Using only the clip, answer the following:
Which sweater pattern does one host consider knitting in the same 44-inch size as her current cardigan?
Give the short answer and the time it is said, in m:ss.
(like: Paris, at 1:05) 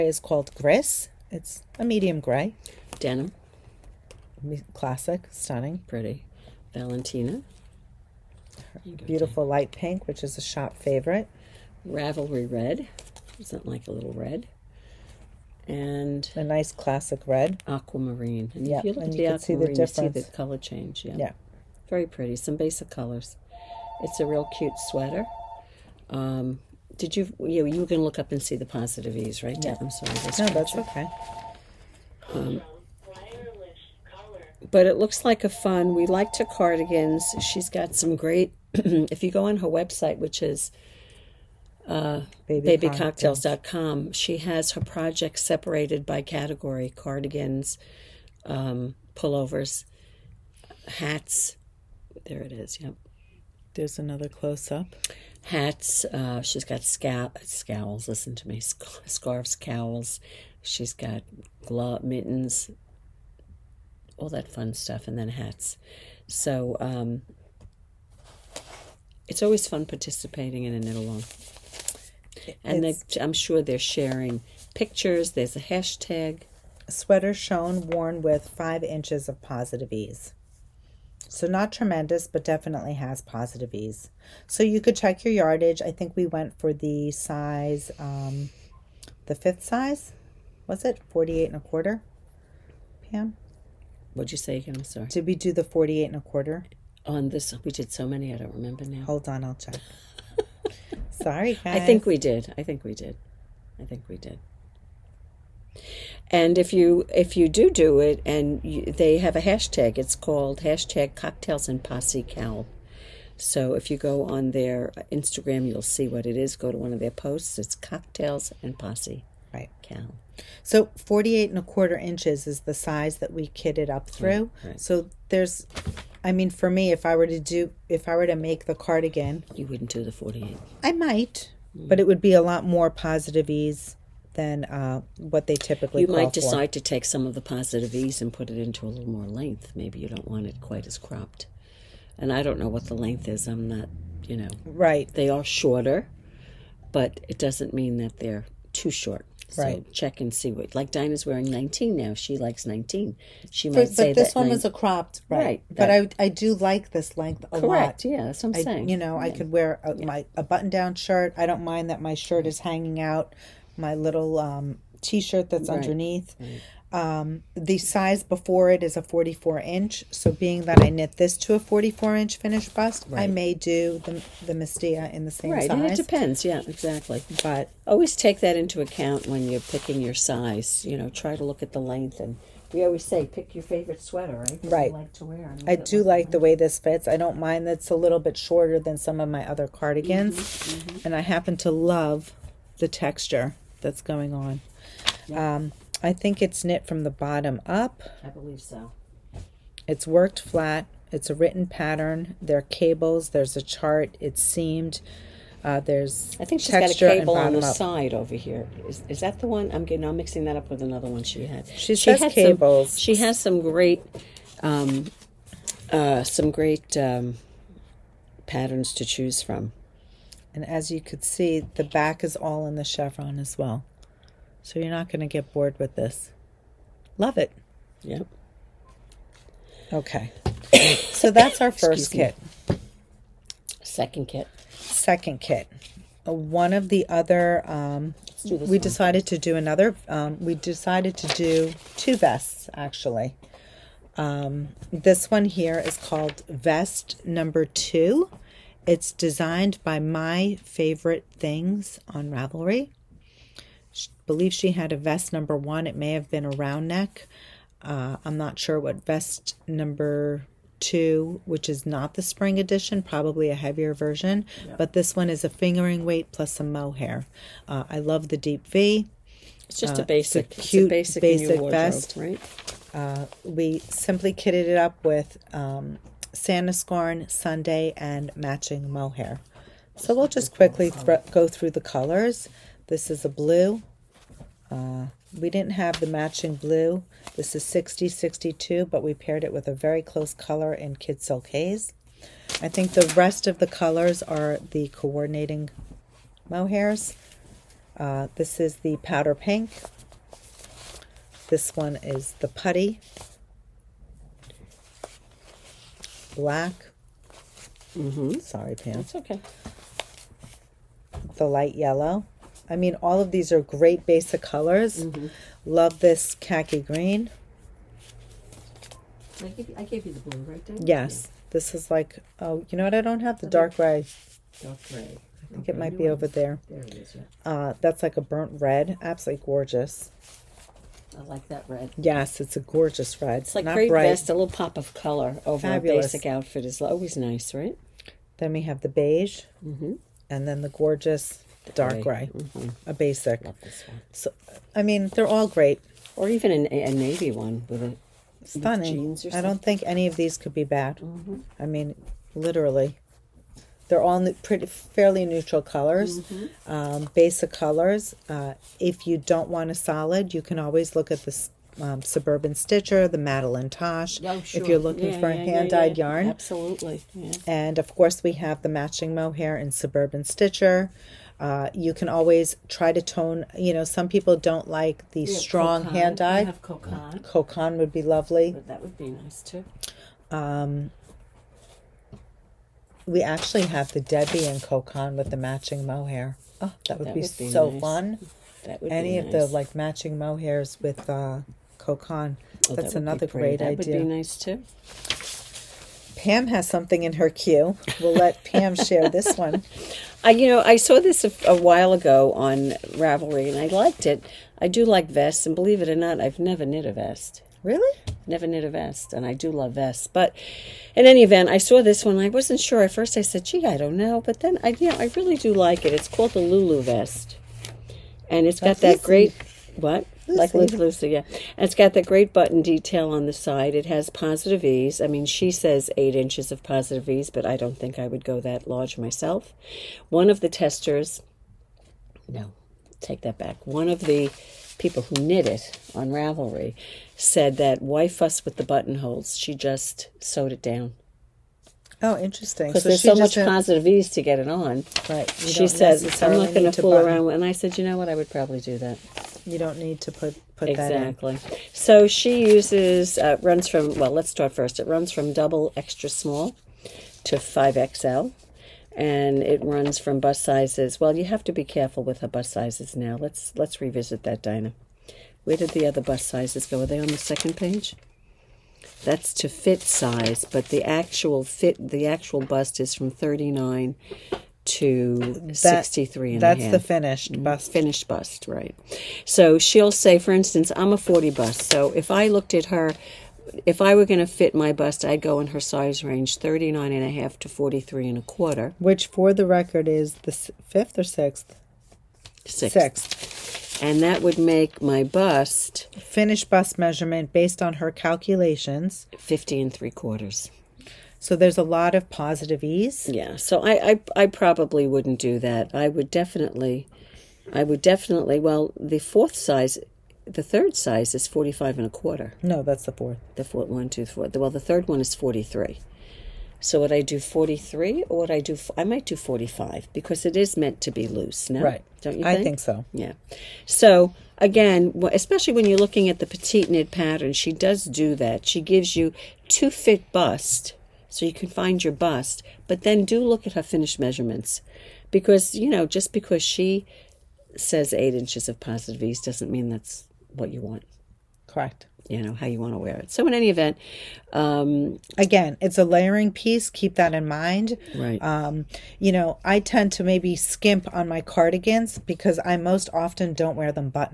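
Mastiha, at 2:54.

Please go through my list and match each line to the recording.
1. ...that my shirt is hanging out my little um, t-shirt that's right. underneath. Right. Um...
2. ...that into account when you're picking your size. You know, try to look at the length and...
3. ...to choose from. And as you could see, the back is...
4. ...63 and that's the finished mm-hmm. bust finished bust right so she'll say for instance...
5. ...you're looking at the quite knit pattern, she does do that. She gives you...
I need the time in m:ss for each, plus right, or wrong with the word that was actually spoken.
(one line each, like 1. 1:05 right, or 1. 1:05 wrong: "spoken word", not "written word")
1. 2:41 right
2. 2:58 right
3. 3:38 right
4. 7:55 right
5. 8:45 wrong: "petite", not "quite".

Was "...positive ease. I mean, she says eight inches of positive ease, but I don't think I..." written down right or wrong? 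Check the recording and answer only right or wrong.
right.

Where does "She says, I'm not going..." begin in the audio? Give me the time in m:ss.
7:25.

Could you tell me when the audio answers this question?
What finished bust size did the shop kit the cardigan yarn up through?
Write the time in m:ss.
2:00.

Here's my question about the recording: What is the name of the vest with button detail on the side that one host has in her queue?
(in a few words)
Lulu vest.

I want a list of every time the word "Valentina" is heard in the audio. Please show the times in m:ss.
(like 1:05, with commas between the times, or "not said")
0:06.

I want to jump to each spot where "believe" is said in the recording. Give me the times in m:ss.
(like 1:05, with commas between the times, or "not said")
3:18, 4:14, 6:45.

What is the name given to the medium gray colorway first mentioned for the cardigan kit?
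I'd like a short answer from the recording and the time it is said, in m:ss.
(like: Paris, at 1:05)
Gris, at 0:00.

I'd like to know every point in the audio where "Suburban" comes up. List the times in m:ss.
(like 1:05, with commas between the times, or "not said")
6:02, 6:09.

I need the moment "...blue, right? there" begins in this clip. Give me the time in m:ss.
5:20.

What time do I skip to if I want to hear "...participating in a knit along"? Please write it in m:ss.
1:09.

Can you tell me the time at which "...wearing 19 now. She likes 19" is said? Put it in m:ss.
2:31.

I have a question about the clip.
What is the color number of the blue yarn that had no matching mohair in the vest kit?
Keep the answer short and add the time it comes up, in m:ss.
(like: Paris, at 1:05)
6062, at 4:47.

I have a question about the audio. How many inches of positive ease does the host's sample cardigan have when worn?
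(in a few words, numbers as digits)
5.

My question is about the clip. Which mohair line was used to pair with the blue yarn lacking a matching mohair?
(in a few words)
Kid Silk Haze.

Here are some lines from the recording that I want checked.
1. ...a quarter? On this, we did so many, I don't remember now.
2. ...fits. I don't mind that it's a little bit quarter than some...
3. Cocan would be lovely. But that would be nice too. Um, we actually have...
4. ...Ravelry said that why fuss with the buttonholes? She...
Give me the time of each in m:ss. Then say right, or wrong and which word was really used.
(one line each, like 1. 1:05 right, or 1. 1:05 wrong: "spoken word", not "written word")
1. 1:36 right
2. 3:06 wrong: "shorter", not "quarter"
3. 6:17 right
4. 7:16 right.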